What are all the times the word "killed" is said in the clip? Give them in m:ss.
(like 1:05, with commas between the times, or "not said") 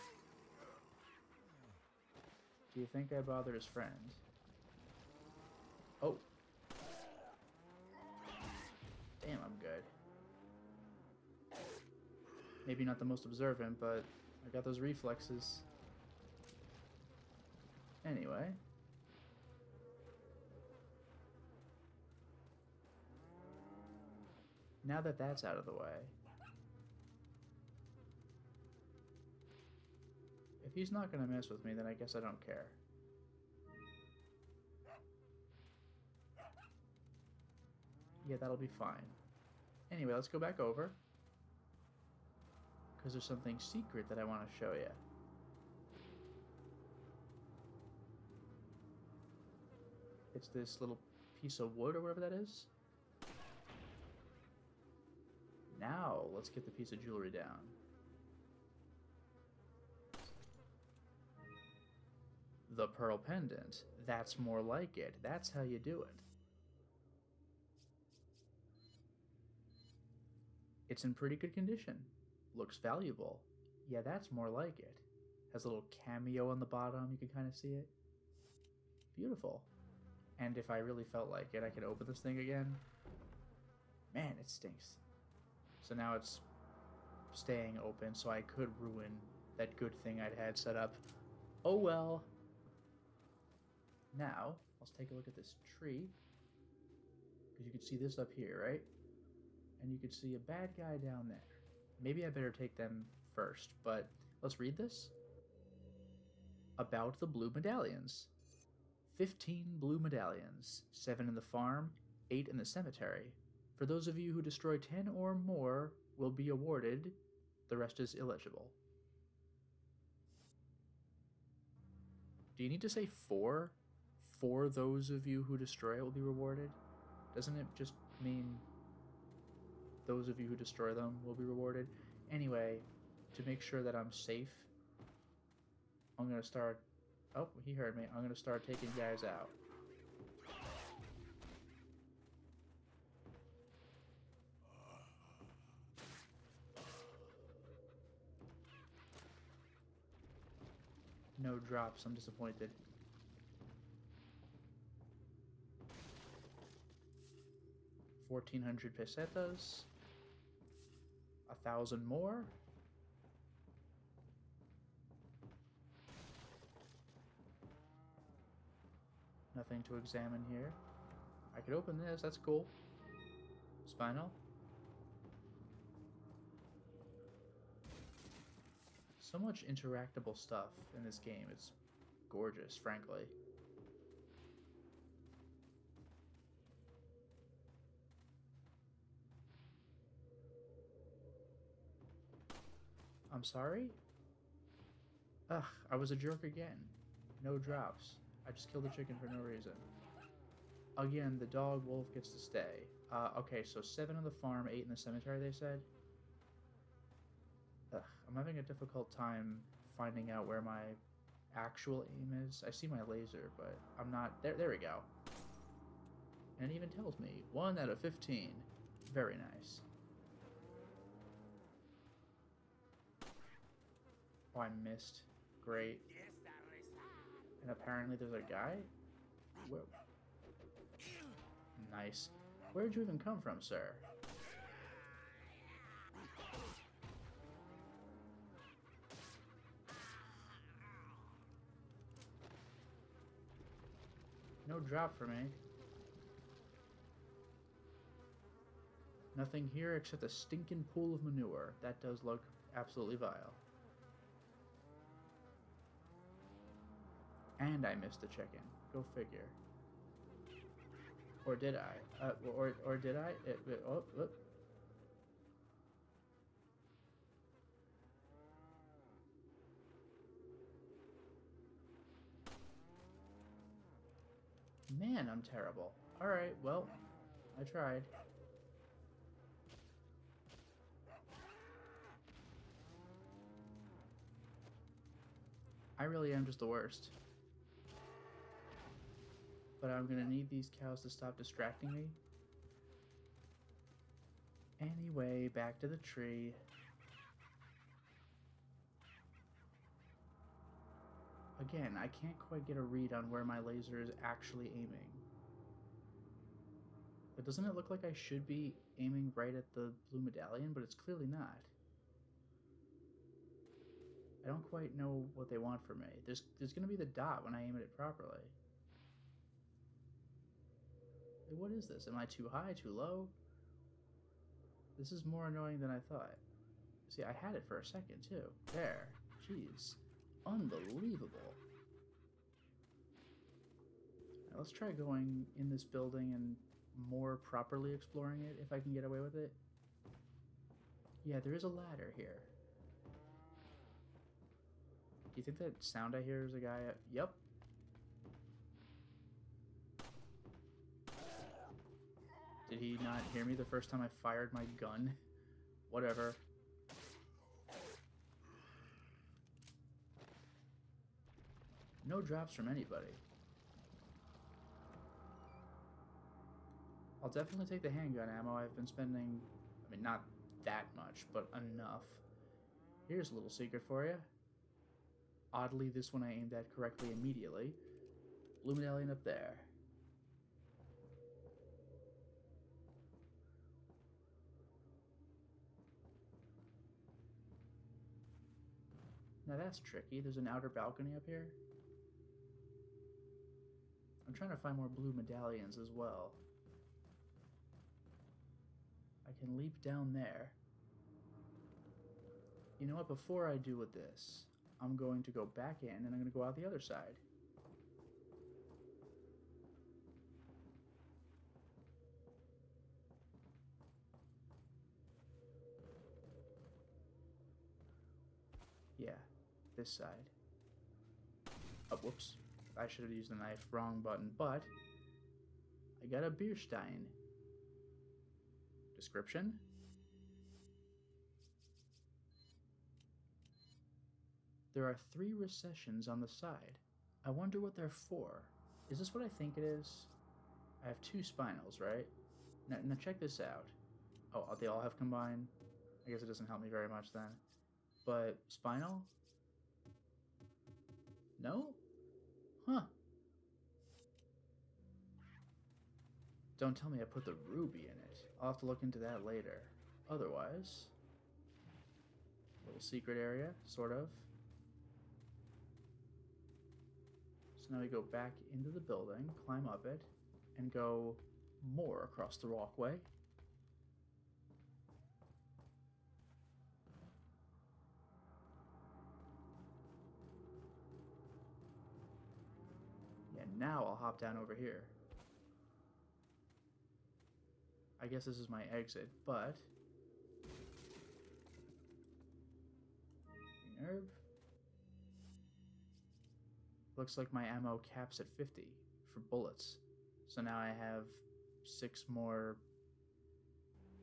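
3:18.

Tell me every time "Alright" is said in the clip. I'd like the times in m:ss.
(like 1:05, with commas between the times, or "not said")
4:36.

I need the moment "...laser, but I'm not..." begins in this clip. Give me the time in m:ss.
3:33.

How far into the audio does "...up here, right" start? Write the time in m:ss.
1:38.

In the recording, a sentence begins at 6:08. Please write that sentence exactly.
I've been spending, I mean, not that much, but enough.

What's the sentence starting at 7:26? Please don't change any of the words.
I guess it doesn't help me very much then.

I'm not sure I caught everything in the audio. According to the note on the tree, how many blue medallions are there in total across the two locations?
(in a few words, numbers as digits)
15.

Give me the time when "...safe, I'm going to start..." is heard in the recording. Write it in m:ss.
2:14.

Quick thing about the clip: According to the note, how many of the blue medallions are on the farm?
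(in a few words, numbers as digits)
7.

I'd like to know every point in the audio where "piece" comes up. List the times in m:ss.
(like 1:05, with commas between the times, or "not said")
0:51, 0:56.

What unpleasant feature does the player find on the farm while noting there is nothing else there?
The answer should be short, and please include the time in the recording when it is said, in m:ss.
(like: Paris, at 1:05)
pool of manure, at 4:10.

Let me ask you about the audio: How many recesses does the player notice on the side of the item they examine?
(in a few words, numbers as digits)
3.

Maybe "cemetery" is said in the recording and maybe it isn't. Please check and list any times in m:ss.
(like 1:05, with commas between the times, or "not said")
1:52, 3:24.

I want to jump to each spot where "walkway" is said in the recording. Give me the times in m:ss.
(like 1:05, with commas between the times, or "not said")
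7:52.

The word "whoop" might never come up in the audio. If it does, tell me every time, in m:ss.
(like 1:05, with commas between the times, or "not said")
4:24, 7:02.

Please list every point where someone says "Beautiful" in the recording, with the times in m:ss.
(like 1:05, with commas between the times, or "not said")
1:19.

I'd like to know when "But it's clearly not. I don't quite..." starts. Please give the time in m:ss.
5:10.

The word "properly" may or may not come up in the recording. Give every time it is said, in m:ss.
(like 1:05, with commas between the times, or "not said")
5:17, 5:37.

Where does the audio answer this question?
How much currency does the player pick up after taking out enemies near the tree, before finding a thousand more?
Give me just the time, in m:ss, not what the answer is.
2:38.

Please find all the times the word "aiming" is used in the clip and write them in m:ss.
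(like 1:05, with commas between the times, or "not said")
5:04, 5:08.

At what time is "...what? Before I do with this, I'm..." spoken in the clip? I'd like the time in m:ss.
6:42.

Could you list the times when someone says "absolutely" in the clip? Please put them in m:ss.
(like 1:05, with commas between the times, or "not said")
4:12.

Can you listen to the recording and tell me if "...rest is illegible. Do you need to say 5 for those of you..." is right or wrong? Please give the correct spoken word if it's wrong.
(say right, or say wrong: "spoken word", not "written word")
wrong: "4", not "5".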